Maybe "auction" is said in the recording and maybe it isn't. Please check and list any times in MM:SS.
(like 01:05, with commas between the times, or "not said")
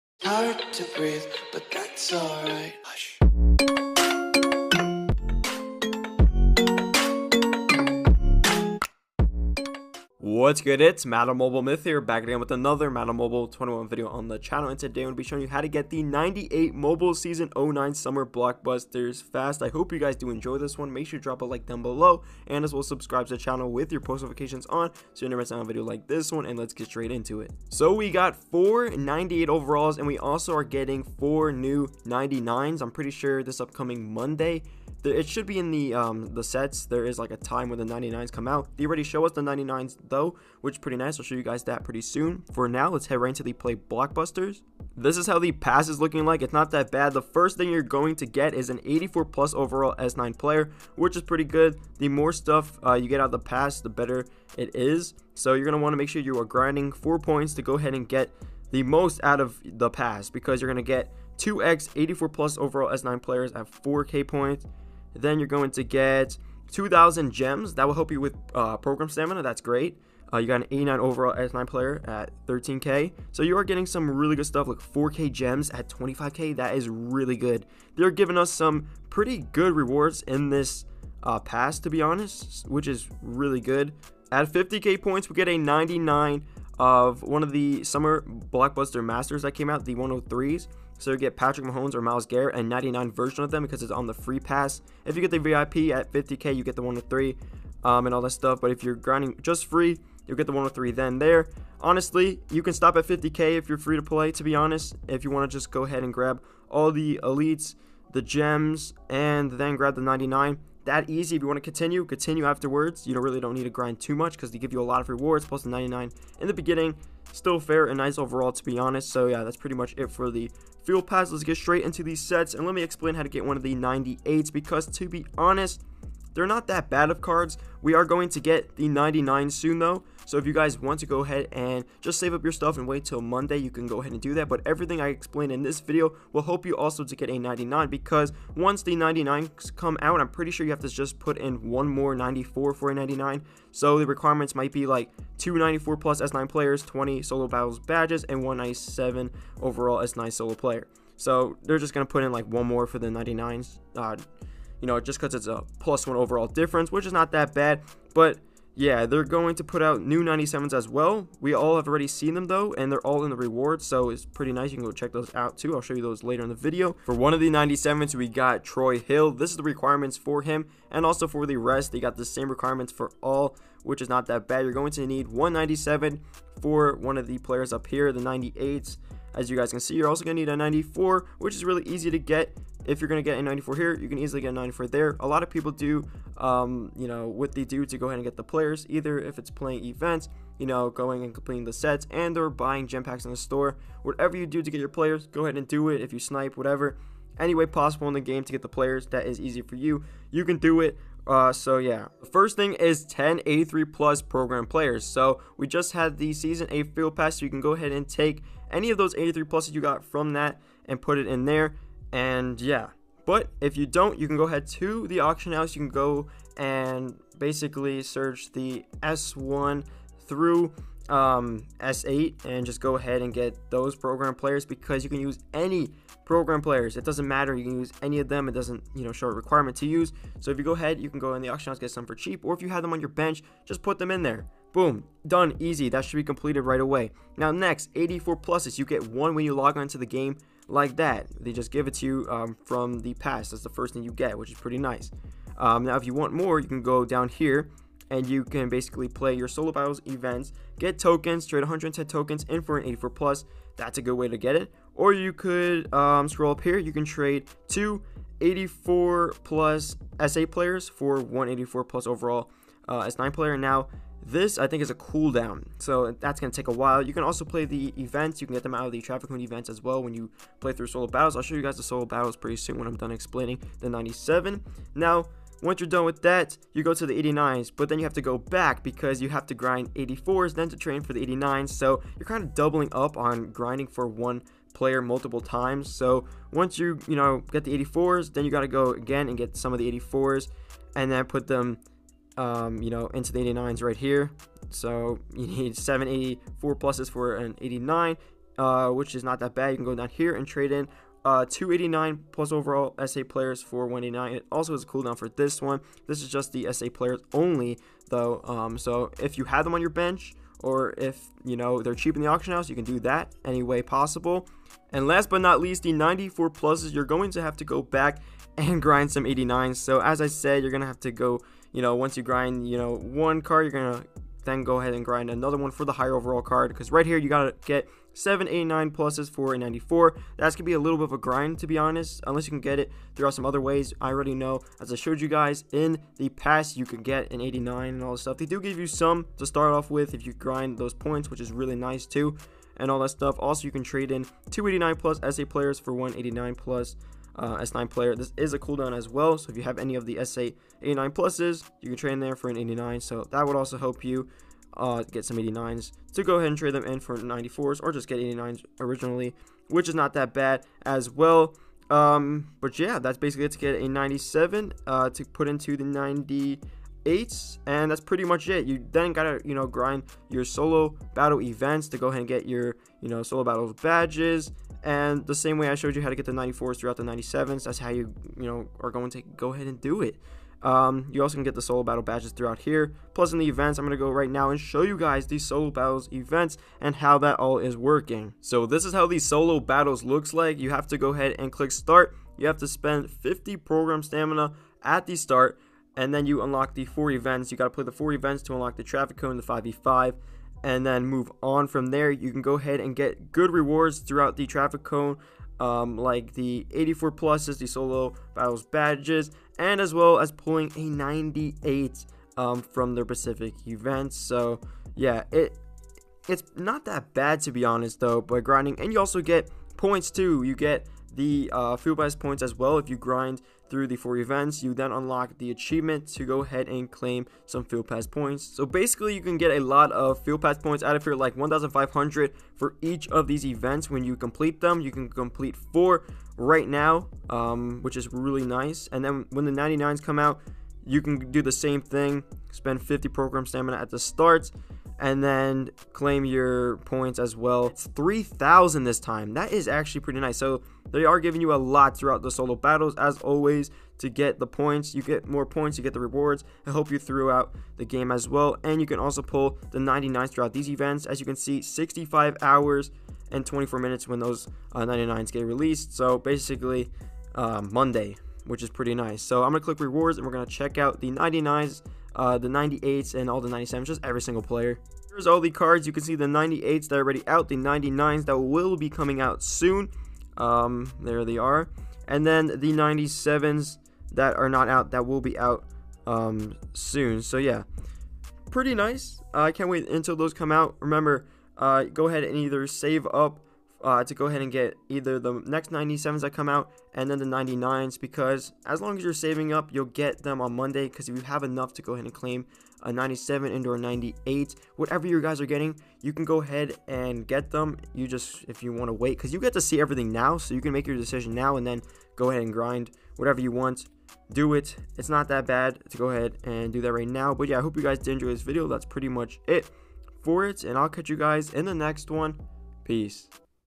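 03:35, 03:51, 05:12.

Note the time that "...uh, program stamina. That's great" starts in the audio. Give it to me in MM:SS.
01:08.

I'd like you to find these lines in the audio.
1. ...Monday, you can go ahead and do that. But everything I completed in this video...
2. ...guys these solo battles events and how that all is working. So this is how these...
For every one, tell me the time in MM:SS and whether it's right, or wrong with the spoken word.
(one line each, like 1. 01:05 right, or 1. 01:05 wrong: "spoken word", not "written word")
1. 02:13 wrong: "explained", not "completed"
2. 06:24 right.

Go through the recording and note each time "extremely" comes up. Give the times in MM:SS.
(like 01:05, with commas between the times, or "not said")
not said.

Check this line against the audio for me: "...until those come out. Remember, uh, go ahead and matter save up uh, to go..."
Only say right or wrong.
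wrong.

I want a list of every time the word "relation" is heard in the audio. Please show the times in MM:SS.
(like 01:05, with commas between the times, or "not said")
not said.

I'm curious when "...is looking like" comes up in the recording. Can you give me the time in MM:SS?
00:45.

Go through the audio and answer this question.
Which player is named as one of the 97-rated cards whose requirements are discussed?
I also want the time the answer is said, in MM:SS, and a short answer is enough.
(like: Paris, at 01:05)
Troy Hill, at 02:48.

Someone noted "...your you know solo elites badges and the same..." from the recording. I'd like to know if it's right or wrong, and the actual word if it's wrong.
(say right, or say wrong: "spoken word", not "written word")
wrong: "battles", not "elites".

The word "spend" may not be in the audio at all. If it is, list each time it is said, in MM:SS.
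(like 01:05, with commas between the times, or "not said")
06:32, 07:22.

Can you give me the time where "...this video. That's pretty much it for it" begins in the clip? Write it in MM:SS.
08:38.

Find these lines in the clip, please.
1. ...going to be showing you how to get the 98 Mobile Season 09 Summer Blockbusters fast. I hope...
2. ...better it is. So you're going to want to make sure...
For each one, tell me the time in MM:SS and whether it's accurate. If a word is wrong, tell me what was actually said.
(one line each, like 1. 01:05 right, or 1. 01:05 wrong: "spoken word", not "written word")
1. 00:15 right
2. 00:53 right.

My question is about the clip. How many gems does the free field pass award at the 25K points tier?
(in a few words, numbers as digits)
4,000 gems.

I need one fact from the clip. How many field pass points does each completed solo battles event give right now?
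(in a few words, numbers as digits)
1,500.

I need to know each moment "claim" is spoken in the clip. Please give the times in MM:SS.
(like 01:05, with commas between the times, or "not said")
07:06, 07:25, 08:22.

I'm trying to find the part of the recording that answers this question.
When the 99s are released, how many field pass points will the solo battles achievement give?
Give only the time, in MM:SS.
07:27.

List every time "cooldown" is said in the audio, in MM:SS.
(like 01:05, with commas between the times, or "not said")
04:24, 05:04, 05:48.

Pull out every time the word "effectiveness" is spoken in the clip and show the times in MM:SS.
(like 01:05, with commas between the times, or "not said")
not said.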